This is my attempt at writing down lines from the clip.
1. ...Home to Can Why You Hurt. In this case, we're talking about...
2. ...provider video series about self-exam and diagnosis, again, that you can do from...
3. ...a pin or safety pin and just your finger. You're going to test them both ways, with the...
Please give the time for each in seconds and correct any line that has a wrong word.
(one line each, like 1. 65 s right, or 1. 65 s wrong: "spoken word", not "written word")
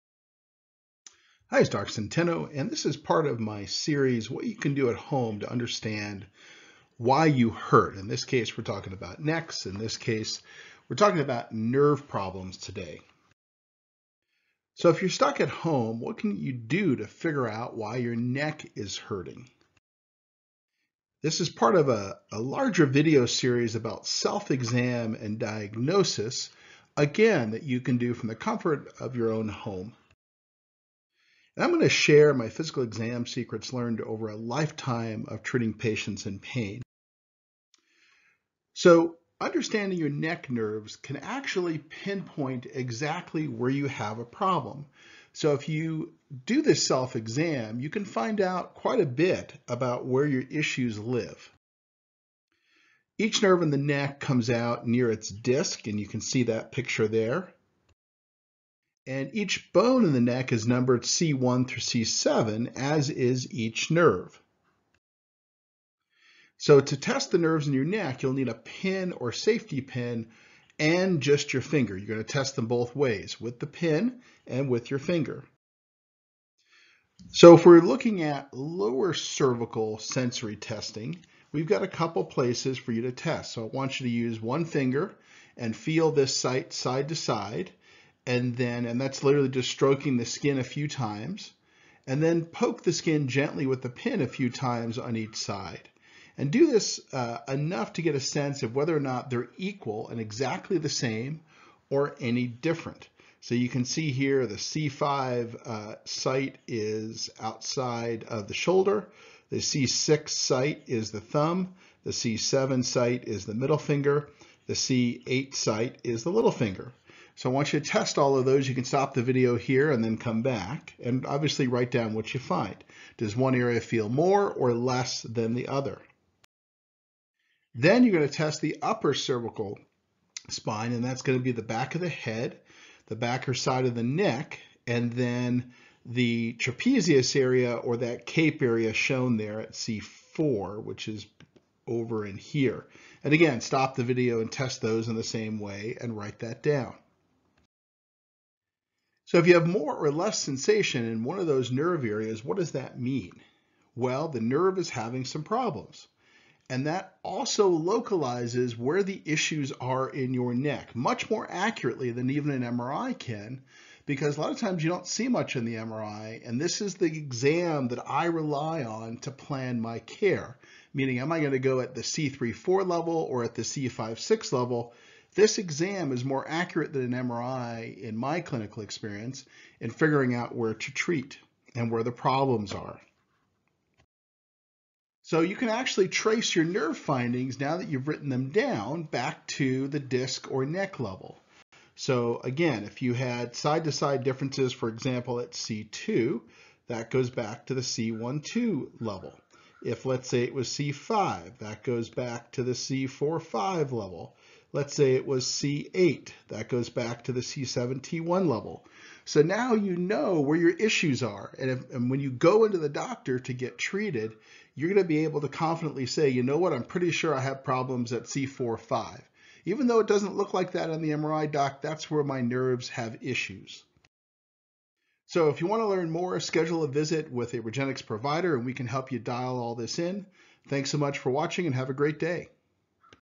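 1. 4 s wrong: "Understand", not "Can"
2. 22 s wrong: "larger", not "provider"
3. 68 s right.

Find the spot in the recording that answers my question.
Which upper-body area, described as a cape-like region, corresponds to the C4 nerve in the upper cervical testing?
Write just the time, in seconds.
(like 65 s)
136 s.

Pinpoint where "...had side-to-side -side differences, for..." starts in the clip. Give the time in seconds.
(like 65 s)
193 s.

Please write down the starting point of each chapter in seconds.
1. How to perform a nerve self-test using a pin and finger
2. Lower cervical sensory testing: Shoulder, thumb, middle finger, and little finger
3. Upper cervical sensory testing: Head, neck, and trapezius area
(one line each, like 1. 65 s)
1. 66 s
2. 102 s
3. 127 s.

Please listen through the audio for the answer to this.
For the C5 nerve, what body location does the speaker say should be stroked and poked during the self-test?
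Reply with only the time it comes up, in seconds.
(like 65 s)
107 s.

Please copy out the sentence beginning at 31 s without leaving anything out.
And I'm going to share my physical exam secrets learned over a lifetime of treating patients in pain.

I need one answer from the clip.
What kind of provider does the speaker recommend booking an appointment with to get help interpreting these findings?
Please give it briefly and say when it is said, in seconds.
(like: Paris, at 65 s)
Regenexx provider, at 227 s.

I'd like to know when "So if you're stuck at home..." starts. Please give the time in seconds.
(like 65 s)
14 s.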